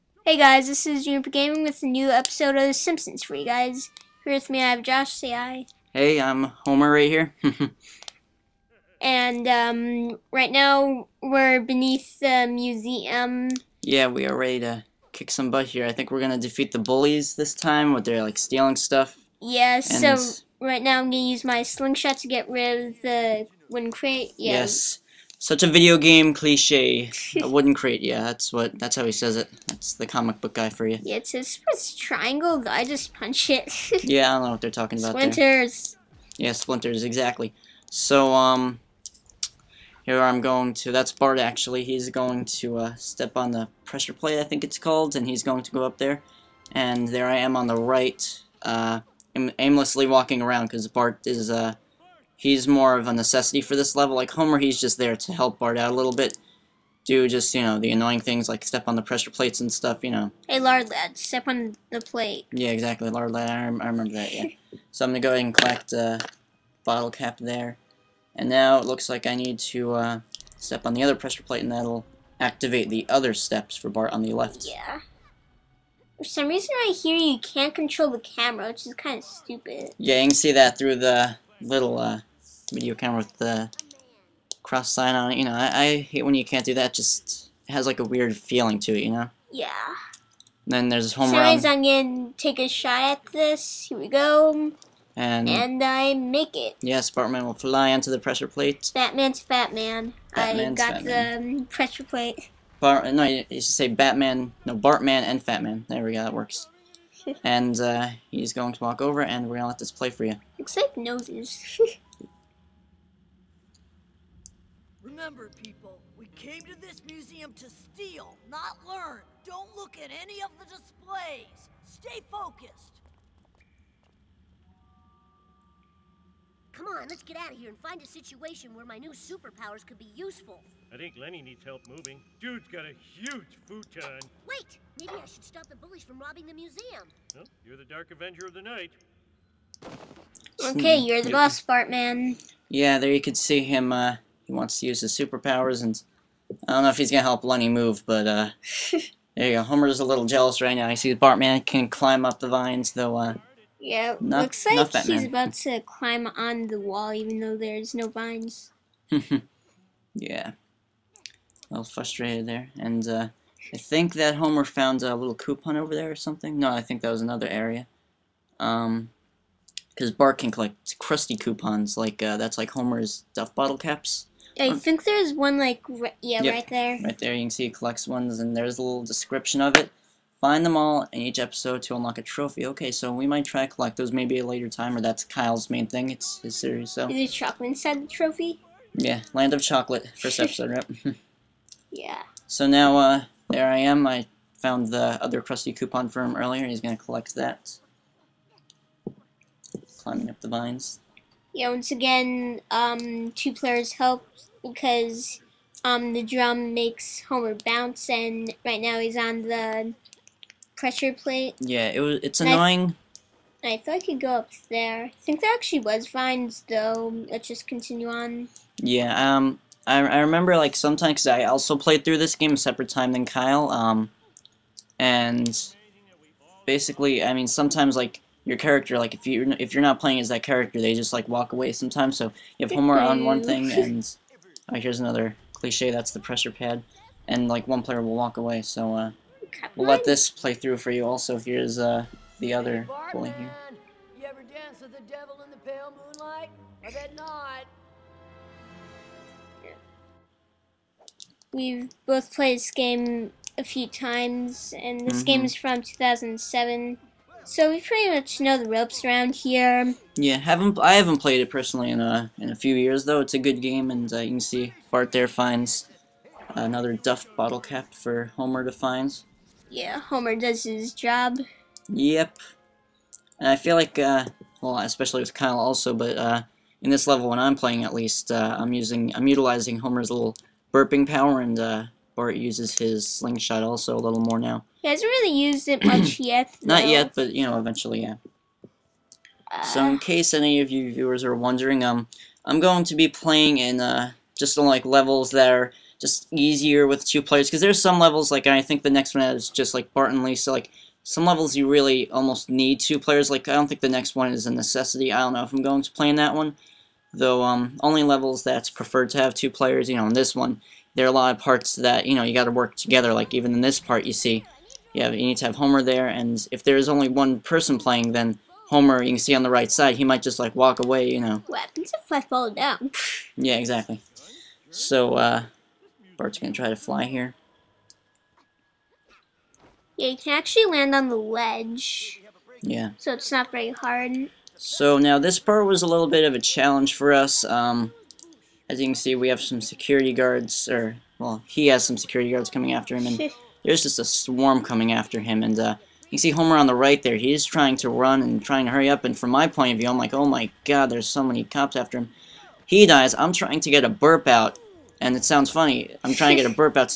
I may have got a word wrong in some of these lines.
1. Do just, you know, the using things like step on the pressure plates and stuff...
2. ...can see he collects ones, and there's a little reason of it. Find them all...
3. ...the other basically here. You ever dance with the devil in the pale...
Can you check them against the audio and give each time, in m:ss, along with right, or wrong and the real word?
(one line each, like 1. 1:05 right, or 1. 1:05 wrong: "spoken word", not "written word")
1. 0:57 wrong: "annoying", not "using"
2. 2:57 wrong: "description", not "reason"
3. 4:02 wrong: "bully", not "basically".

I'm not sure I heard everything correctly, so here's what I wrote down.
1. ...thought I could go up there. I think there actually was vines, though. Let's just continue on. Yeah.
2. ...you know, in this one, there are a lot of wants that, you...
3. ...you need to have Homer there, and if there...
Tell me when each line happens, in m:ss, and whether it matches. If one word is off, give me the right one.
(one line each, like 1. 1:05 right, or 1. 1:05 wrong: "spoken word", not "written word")
1. 3:33 right
2. 5:09 wrong: "parts", not "wants"
3. 5:15 right.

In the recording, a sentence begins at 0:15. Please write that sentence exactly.
I think we're gonna defeat the bullies this time with their like stealing stuff.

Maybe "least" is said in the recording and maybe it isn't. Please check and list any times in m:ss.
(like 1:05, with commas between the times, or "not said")
4:37.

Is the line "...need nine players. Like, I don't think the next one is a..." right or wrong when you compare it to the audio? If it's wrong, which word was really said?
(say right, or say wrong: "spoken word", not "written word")
wrong: "two", not "nine".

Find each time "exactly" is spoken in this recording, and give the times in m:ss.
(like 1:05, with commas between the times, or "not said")
0:37, 1:02, 5:23.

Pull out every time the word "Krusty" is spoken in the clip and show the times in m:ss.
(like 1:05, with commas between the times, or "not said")
2:50, 3:15.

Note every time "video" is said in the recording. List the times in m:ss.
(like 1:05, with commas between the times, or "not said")
0:25, 1:22.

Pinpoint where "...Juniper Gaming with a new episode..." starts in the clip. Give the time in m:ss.
0:01.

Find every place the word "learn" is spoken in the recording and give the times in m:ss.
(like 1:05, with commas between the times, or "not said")
1:58.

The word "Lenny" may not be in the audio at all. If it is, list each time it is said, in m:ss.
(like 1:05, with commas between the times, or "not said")
2:11, 2:27.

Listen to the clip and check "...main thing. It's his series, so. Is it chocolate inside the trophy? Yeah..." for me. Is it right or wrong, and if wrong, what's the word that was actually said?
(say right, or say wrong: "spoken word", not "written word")
right.